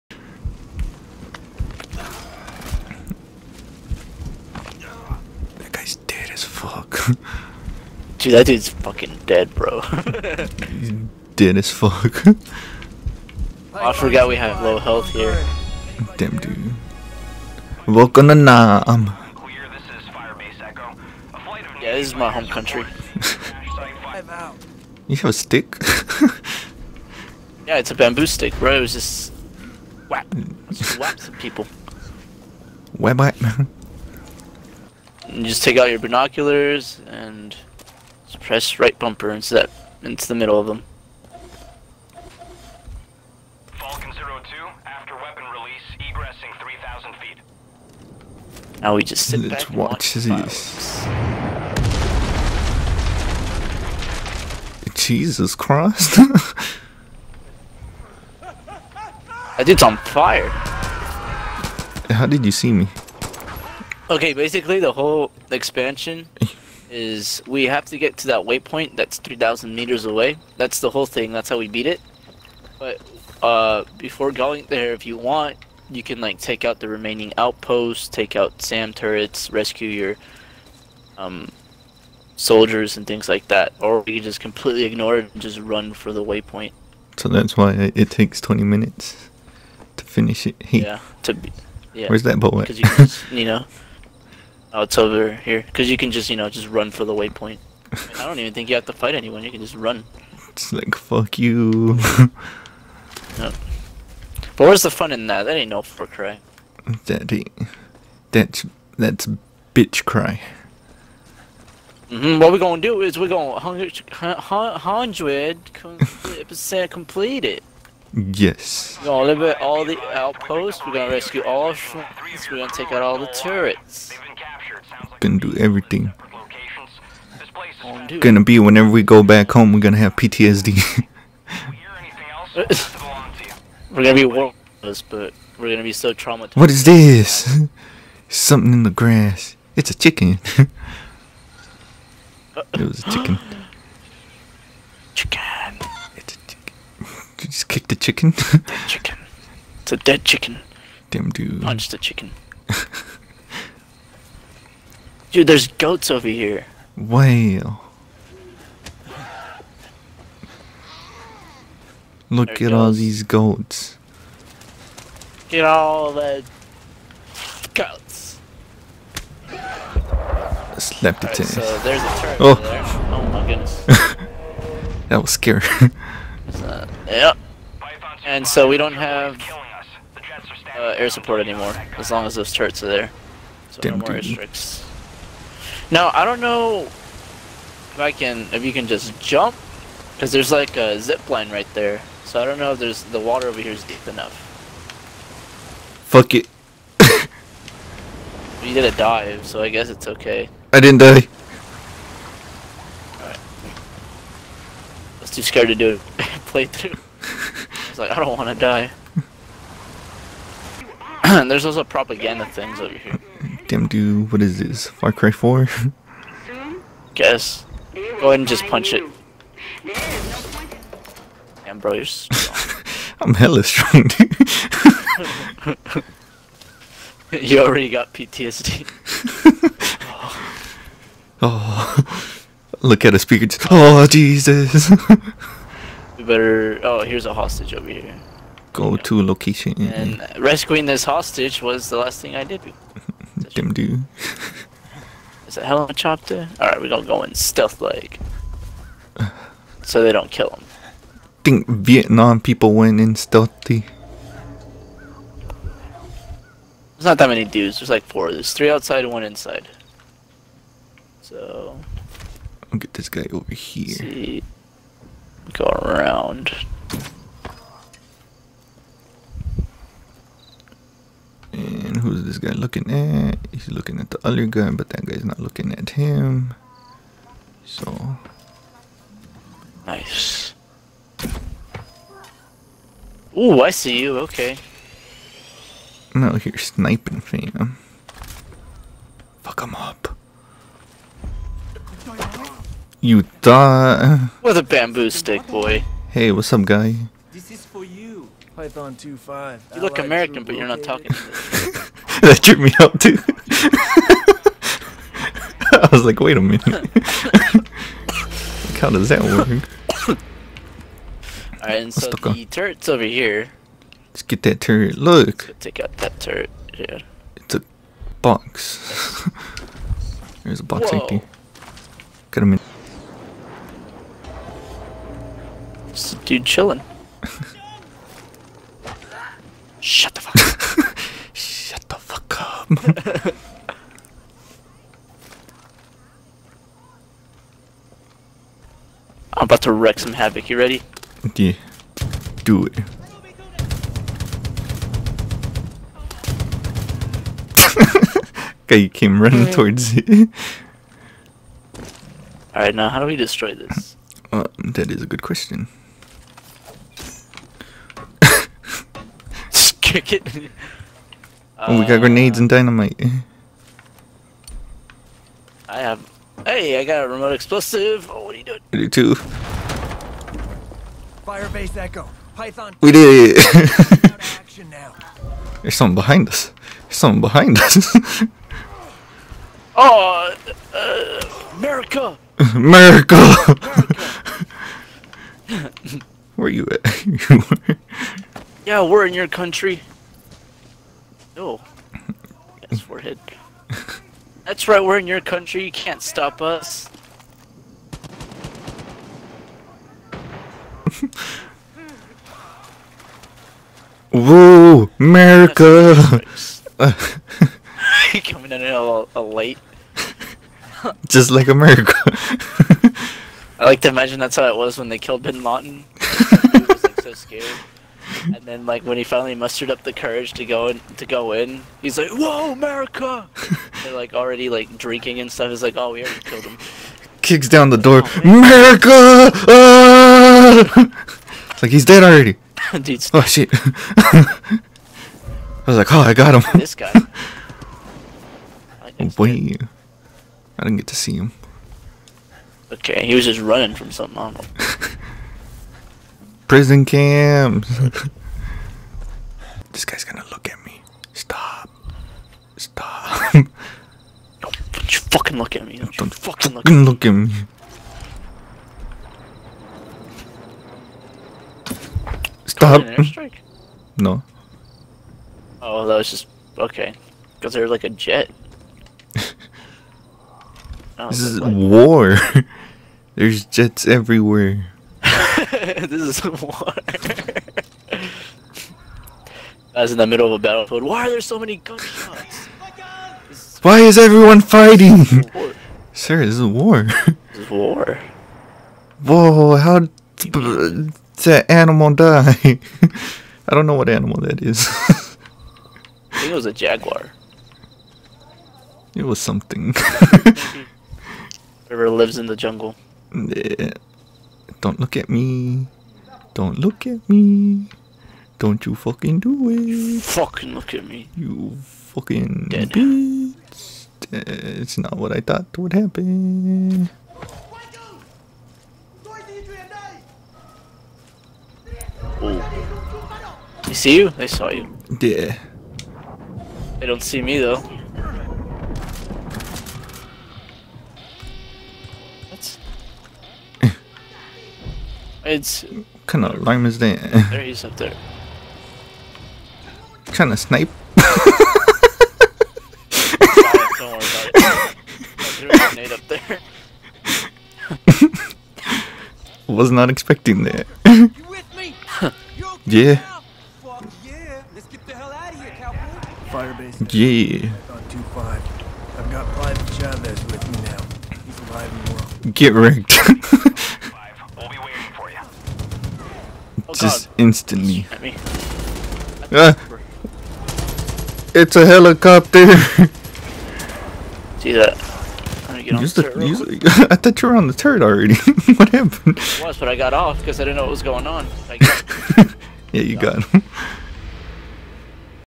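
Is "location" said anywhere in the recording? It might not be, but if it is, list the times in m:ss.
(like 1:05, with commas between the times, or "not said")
3:59.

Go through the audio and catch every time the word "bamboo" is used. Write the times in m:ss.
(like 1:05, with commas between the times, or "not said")
0:27, 4:54.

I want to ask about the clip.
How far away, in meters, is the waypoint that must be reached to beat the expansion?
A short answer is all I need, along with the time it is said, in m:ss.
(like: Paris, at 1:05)
3,000 meters, at 1:09.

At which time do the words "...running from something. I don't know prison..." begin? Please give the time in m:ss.
7:23.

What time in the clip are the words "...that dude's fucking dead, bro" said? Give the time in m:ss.
0:08.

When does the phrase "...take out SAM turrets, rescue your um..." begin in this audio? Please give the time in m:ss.
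1:18.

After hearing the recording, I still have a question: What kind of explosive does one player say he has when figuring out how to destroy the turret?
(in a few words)
Remote explosive.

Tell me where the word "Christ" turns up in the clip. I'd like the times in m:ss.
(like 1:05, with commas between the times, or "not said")
0:55.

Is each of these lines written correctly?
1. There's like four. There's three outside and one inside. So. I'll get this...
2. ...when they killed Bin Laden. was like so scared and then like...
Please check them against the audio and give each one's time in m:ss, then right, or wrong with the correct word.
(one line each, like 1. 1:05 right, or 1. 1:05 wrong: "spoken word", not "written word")
1. 4:17 right
2. 6:54 right.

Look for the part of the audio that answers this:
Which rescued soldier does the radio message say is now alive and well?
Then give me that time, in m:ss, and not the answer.
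9:19.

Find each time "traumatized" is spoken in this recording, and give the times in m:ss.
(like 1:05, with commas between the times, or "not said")
2:16.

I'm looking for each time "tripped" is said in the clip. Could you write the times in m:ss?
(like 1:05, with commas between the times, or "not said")
5:02.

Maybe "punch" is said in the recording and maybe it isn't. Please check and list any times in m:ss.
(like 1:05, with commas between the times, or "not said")
2:31, 3:38.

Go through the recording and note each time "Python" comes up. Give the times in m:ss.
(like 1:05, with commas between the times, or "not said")
4:58, 6:12.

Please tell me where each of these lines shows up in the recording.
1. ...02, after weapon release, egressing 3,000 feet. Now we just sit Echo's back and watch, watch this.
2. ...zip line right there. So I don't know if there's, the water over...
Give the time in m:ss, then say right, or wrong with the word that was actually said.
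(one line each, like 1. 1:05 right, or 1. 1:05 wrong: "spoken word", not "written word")
1. 0:44 wrong: "Let", not "Echo"
2. 3:10 right.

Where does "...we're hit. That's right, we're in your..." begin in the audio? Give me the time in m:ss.
6:32.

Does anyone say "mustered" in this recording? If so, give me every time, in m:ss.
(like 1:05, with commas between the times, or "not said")
6:59.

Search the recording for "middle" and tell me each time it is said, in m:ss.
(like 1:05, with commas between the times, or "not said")
0:40, 8:00.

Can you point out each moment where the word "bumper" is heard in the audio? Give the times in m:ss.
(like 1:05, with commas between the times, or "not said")
0:38.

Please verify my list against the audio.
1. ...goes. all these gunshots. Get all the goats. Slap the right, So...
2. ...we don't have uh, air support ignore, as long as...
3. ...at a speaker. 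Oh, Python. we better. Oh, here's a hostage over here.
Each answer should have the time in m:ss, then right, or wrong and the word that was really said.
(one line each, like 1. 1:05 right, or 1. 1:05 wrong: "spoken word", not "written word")
1. 2:42 wrong: "goats", not "gunshots"
2. 2:58 wrong: "anymore", not "ignore"
3. 3:53 wrong: "Jesus", not "Python".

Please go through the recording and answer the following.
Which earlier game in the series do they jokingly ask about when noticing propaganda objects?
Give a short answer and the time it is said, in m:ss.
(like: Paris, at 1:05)
Far Cry 4, at 3:34.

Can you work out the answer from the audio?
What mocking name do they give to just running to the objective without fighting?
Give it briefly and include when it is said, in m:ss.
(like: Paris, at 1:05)
Bitch cry, at 1:49.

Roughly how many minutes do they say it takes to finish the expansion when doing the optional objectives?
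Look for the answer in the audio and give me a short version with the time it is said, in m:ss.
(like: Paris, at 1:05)
20 minutes, at 1:28.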